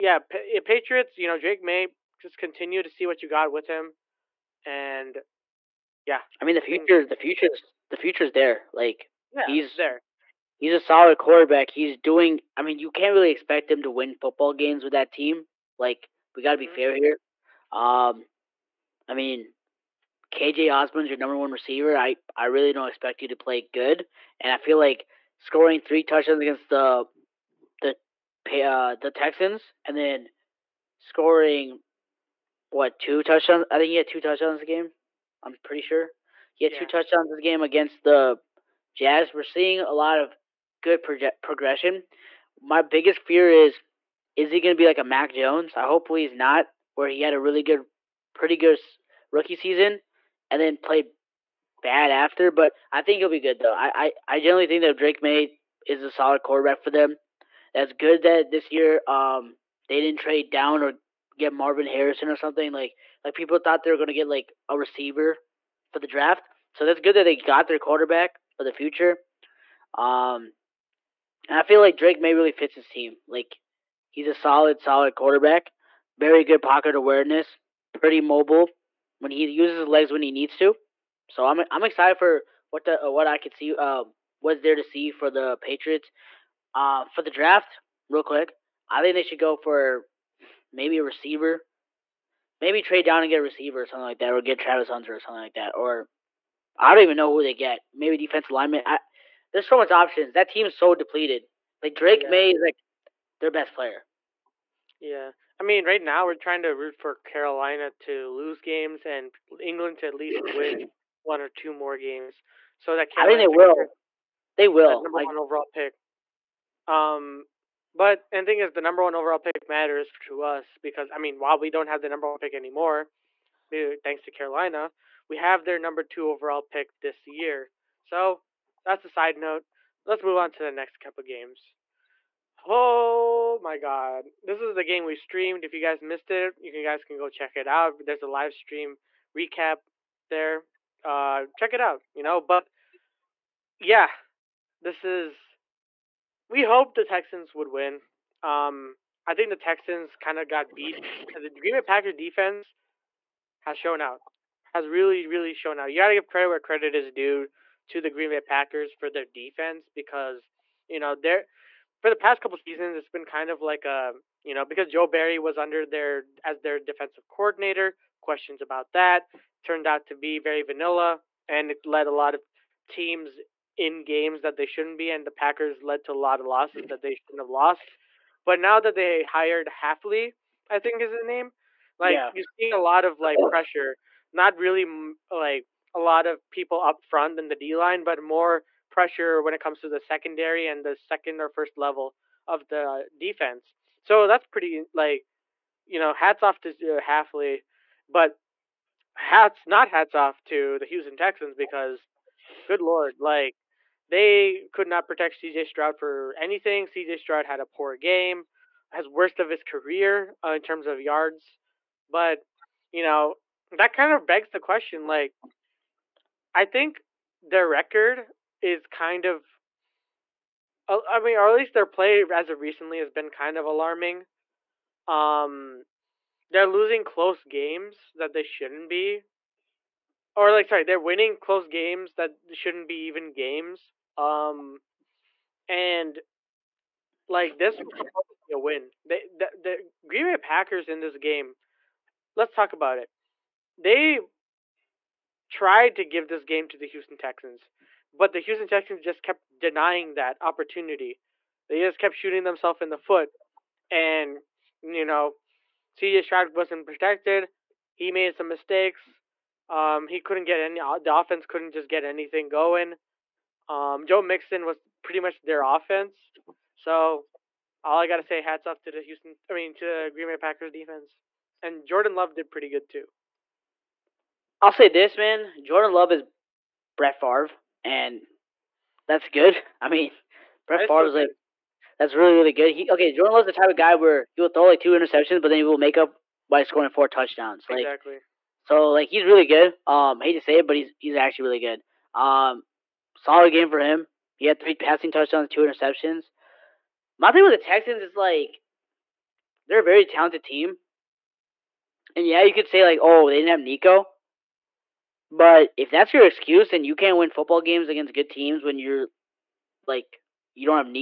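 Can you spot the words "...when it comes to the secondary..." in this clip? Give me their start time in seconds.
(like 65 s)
189 s.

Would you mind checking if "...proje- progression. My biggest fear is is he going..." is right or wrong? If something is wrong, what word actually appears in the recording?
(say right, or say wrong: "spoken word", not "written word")
right.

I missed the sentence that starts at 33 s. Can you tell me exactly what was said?
I think he had two touchdowns a game.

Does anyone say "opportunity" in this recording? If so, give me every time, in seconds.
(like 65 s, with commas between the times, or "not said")
250 s.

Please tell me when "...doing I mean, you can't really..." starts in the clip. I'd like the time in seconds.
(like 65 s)
11 s.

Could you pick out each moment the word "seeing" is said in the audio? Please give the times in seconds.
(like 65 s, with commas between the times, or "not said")
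39 s, 182 s.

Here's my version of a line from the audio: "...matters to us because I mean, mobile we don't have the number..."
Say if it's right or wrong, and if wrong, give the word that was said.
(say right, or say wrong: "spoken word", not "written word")
wrong: "while", not "mobile".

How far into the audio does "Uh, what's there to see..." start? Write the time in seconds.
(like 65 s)
83 s.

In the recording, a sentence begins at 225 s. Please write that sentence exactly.
Um, they're losing close games that they shouldn't be or like sorry, they're winning close games that shouldn't be even games.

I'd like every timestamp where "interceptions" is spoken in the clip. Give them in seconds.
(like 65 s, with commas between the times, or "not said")
284 s, 295 s.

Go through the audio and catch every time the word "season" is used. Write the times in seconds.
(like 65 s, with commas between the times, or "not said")
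49 s, 162 s.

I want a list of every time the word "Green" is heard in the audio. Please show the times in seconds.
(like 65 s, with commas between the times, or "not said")
151 s, 158 s, 240 s, 270 s.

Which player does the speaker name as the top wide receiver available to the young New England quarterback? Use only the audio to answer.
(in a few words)
KJ Osborn.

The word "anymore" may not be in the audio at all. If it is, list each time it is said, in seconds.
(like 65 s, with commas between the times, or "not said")
122 s.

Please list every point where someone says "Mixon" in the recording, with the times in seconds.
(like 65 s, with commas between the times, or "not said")
264 s.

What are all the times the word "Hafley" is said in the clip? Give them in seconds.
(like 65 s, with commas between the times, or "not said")
179 s, 197 s.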